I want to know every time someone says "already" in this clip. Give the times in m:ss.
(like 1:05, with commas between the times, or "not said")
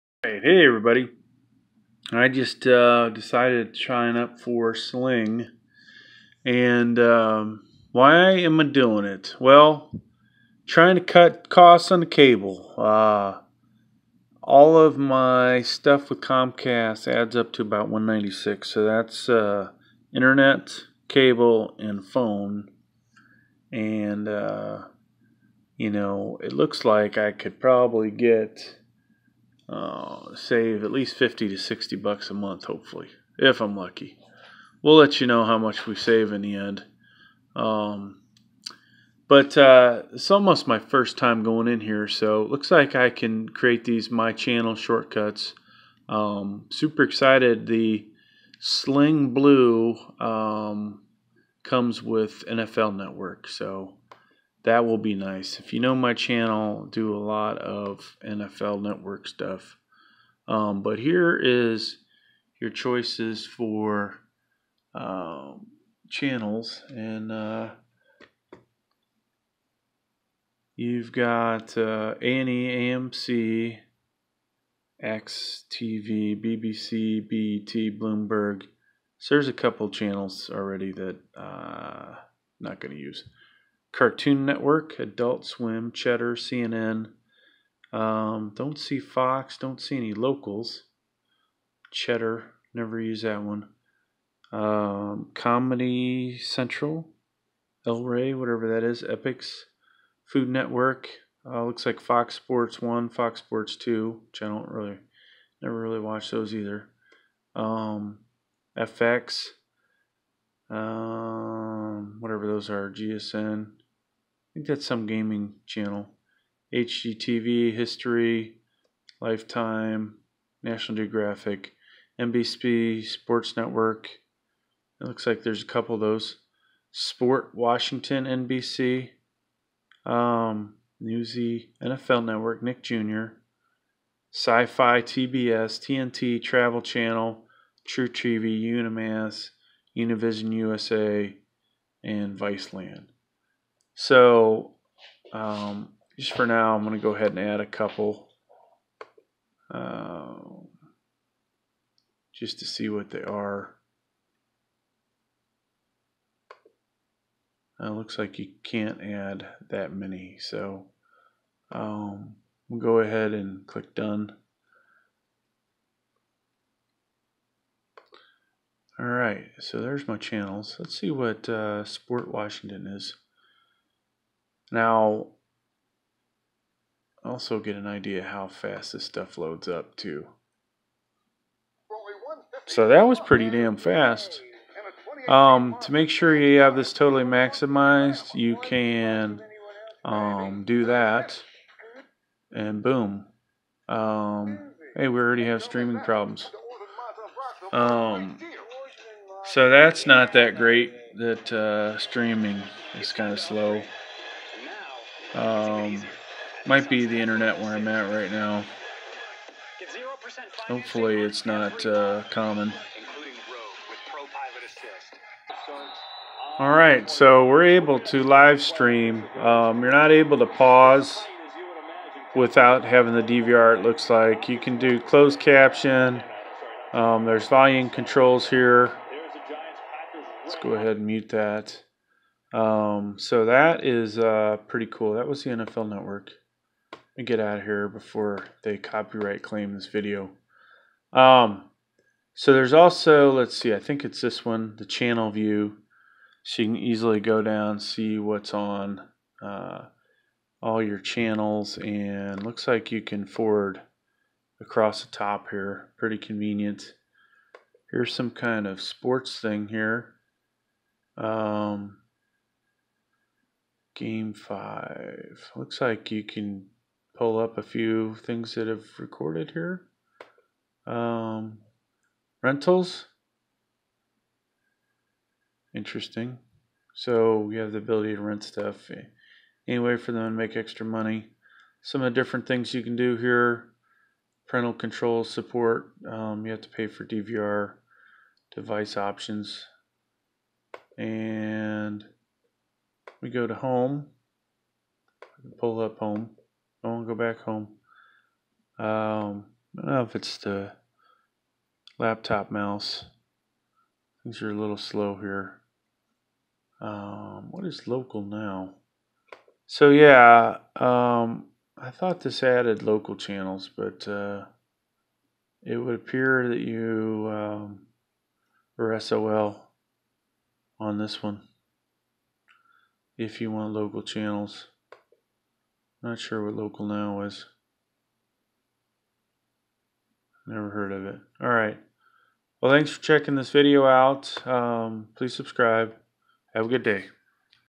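1:20, 3:15.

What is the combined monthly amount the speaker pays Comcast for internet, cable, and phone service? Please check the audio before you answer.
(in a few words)
$196.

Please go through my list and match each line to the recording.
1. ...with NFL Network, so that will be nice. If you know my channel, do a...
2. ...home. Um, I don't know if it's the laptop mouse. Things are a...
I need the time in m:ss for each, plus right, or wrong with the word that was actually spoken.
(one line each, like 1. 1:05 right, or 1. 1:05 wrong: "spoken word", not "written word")
1. 0:52 right
2. 4:57 right.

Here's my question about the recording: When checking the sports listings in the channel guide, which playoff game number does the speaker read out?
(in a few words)
Game five.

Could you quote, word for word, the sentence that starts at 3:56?
Let me get out of here before they copyright claim this video.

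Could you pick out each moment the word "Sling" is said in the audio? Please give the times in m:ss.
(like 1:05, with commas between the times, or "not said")
0:04, 0:48.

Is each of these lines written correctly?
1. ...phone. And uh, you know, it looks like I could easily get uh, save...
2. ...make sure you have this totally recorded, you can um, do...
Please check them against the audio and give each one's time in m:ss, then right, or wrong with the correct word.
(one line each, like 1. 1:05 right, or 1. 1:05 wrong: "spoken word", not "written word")
1. 0:22 wrong: "probably", not "easily"
2. 3:05 wrong: "maximized", not "recorded".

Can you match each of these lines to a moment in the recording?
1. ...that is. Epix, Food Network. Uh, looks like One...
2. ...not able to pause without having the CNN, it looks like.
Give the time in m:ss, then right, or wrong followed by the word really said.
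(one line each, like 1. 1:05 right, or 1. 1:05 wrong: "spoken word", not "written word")
1. 1:38 wrong: "Fox", not "One"
2. 3:39 wrong: "DVR", not "CNN".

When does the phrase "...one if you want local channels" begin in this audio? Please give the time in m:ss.
5:21.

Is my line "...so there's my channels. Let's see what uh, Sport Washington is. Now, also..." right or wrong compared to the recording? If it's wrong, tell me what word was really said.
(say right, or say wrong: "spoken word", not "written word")
right.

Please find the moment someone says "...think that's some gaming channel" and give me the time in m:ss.
1:54.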